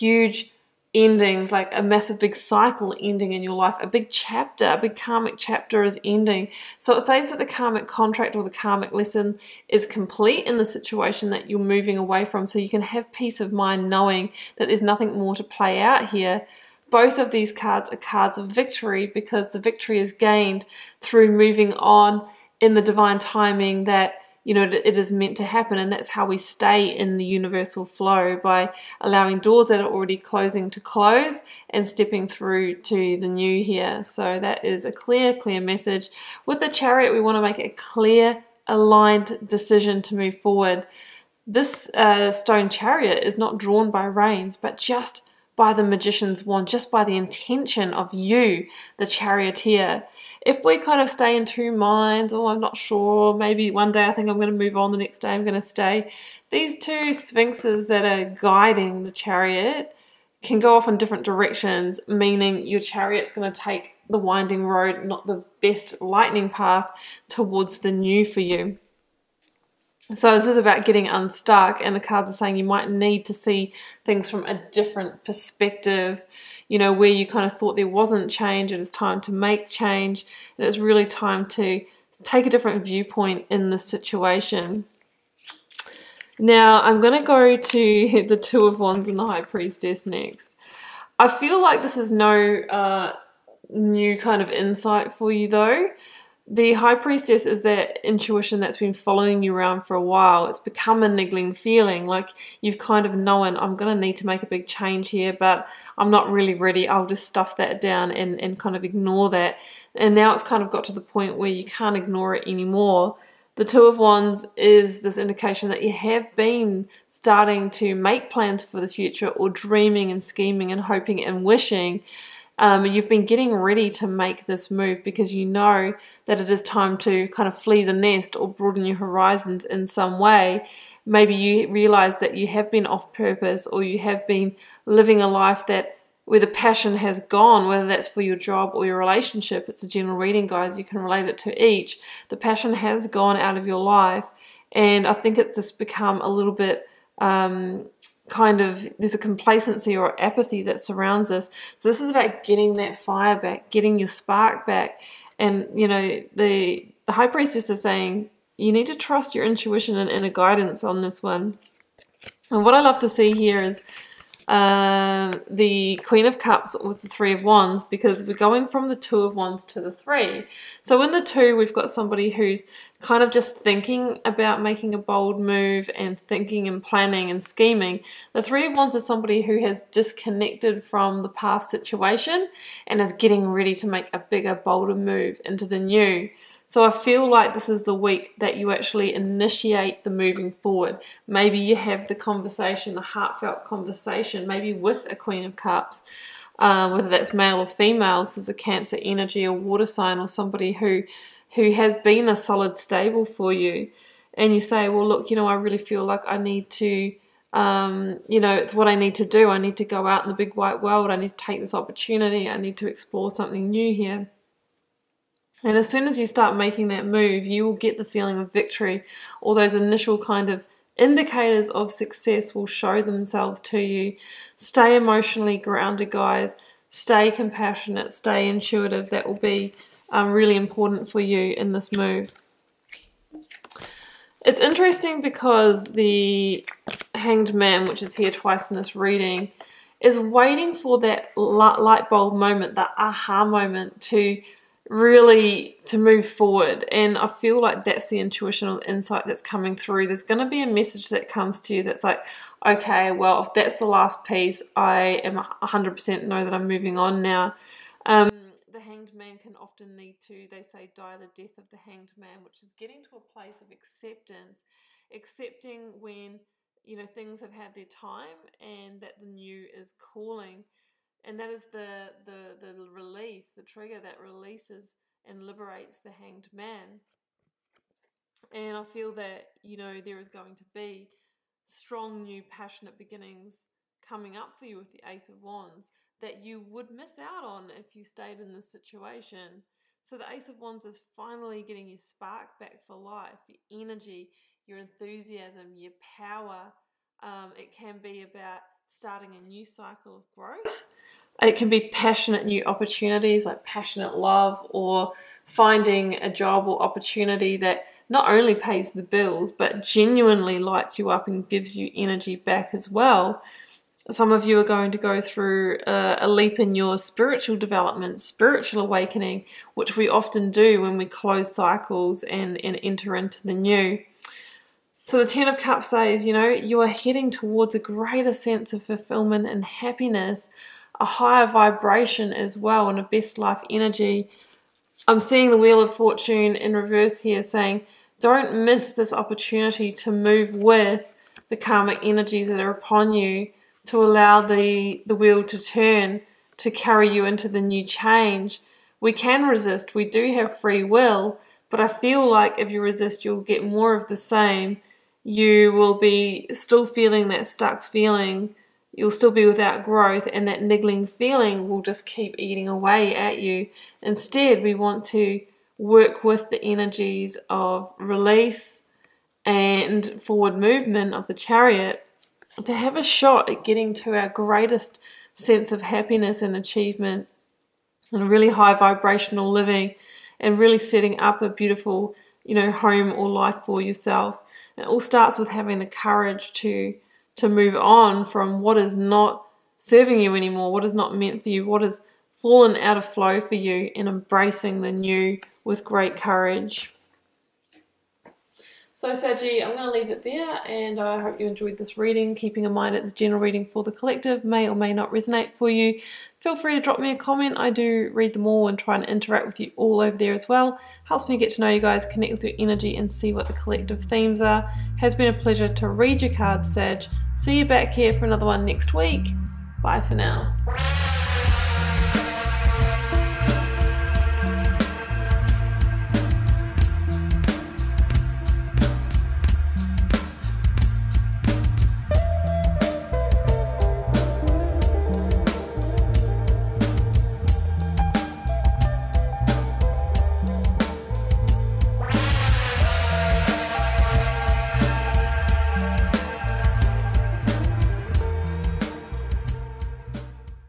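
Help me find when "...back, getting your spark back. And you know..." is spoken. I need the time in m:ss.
2:33.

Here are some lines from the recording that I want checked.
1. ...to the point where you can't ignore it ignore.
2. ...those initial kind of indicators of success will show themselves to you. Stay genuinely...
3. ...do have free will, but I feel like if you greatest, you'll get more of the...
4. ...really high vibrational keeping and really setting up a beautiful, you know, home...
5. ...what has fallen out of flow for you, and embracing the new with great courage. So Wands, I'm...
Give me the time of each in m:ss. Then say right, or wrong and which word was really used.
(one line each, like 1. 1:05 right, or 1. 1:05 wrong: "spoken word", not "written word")
1. 1:50 wrong: "anymore", not "ignore"
2. 3:39 wrong: "emotionally", not "genuinely"
3. 5:50 wrong: "resist", not "greatest"
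4. 6:18 wrong: "living", not "keeping"
5. 6:31 wrong: "Saji", not "Wands".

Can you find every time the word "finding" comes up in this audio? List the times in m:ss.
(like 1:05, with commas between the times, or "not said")
5:05.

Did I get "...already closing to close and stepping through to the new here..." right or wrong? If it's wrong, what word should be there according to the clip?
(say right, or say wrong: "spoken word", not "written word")
right.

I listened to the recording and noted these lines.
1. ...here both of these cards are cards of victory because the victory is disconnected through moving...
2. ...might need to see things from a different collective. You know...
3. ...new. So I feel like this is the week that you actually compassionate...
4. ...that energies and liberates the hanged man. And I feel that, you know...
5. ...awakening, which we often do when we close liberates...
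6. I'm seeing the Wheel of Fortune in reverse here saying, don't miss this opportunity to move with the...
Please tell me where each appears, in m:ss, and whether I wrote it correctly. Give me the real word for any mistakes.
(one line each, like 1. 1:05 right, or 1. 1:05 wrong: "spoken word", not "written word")
1. 0:16 wrong: "gained", not "disconnected"
2. 1:12 wrong: "perspective", not "collective"
3. 3:05 wrong: "initiate", not "compassionate"
4. 4:33 wrong: "releases", not "energies"
5. 5:18 wrong: "cycles", not "liberates"
6. 5:35 right.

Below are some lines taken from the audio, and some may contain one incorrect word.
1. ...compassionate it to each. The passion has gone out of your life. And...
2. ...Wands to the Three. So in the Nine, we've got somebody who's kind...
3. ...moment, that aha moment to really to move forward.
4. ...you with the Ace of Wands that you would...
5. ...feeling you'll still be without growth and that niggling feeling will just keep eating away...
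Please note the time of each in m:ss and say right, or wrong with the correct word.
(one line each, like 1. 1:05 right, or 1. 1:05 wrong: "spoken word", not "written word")
1. 2:20 wrong: "relate", not "compassionate"
2. 2:49 wrong: "Two", not "Nine"
3. 4:02 right
4. 4:44 right
5. 5:57 right.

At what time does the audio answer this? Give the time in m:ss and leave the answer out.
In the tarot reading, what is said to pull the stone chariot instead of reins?
0:45.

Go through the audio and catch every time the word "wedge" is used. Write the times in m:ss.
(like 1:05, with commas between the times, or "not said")
not said.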